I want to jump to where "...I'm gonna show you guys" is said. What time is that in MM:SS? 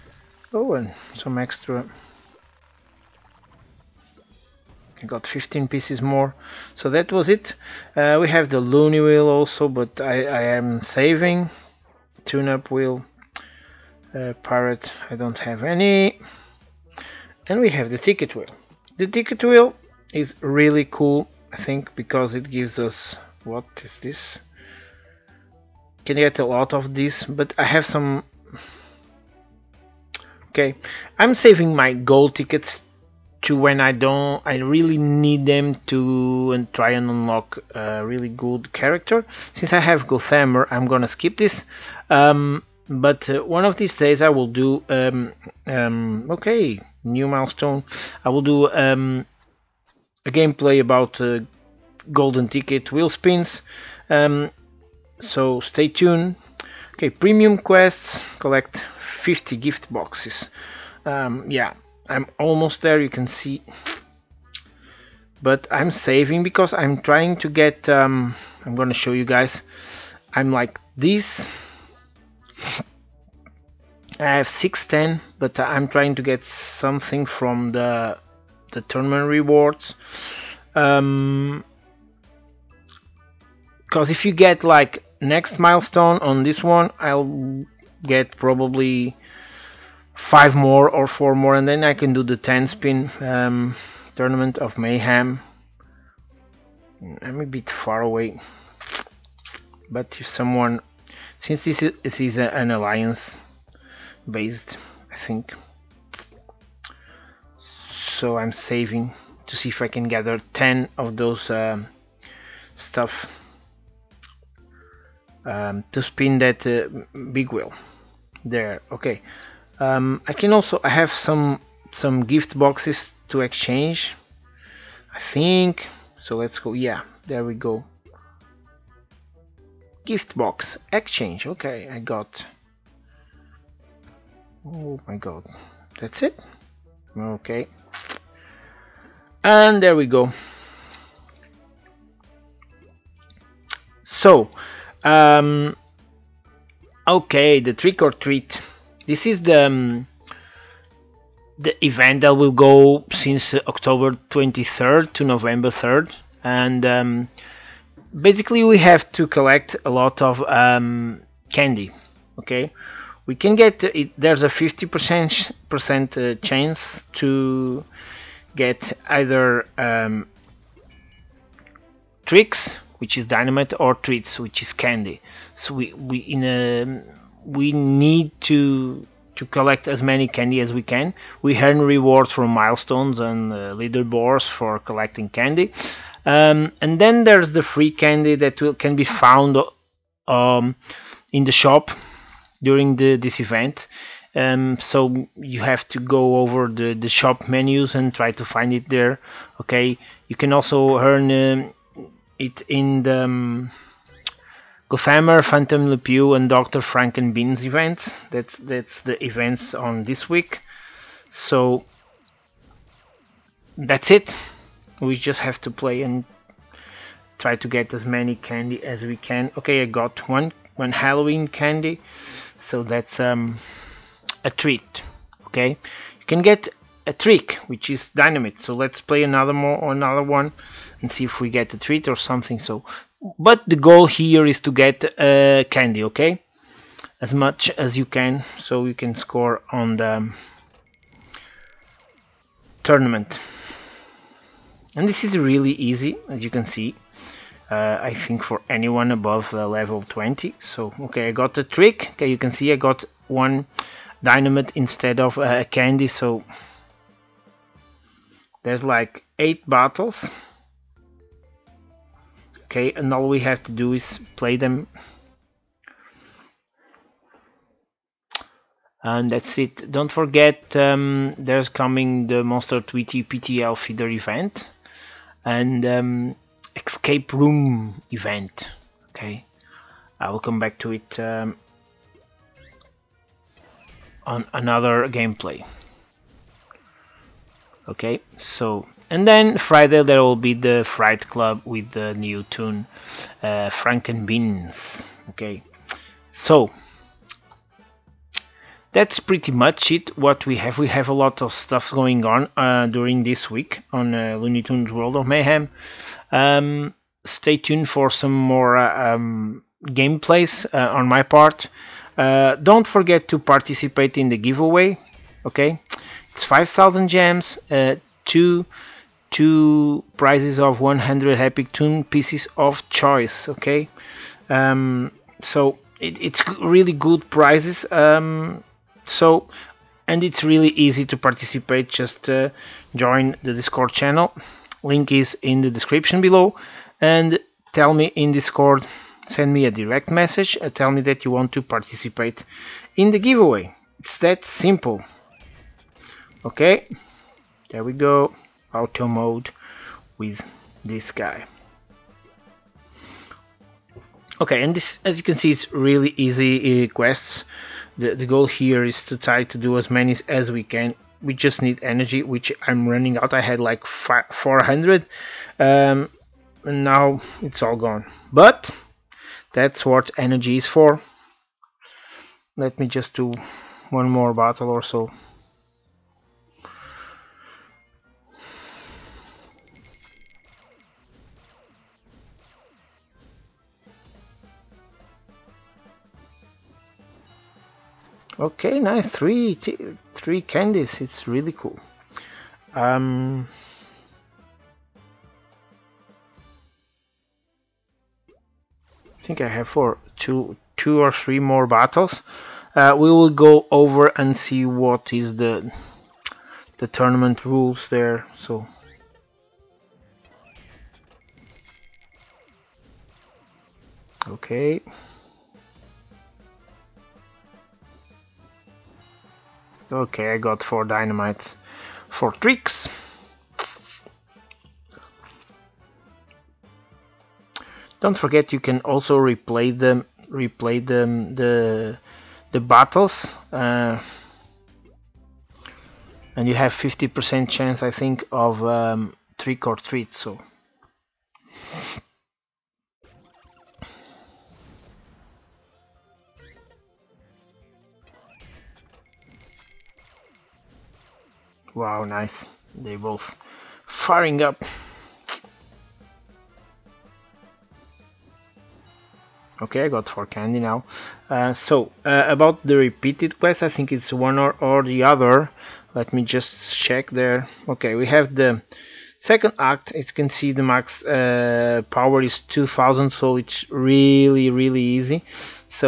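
01:08.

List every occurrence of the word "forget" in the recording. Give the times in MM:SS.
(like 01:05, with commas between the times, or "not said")
04:30, 05:12, 07:08.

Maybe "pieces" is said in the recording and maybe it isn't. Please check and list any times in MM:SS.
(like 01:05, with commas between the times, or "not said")
00:05, 05:22.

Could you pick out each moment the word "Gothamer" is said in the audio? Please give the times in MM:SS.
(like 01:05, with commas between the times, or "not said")
00:40, 03:24.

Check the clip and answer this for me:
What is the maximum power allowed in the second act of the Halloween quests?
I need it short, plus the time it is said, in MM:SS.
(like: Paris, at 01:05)
2000, at 07:52.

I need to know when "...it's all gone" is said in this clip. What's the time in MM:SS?
06:07.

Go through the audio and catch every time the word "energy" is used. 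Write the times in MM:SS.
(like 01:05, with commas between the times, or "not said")
06:01, 06:10.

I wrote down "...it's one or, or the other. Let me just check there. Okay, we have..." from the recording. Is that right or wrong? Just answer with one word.
right.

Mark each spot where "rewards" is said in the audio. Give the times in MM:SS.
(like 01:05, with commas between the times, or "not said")
01:19, 03:01.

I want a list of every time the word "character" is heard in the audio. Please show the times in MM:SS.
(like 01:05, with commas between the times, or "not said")
00:38.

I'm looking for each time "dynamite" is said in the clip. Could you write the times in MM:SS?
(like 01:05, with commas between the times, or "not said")
02:53, 03:48, 04:14, 07:00.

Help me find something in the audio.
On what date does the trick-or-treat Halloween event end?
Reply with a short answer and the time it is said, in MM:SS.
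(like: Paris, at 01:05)
November 3rd, at 02:35.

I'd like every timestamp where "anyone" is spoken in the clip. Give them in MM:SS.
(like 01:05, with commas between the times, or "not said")
04:08.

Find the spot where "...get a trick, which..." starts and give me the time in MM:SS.
03:46.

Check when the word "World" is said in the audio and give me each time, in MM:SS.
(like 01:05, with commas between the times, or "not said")
05:04.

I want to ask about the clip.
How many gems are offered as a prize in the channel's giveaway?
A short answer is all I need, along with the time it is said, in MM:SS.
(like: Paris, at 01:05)
5,000, at 05:16.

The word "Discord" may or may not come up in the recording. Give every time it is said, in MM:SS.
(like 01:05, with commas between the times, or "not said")
05:33, 05:38.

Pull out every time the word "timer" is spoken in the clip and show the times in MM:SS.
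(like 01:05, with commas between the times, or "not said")
not said.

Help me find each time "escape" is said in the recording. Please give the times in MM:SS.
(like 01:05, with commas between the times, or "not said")
04:36.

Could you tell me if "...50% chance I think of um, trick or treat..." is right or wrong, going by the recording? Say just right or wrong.
right.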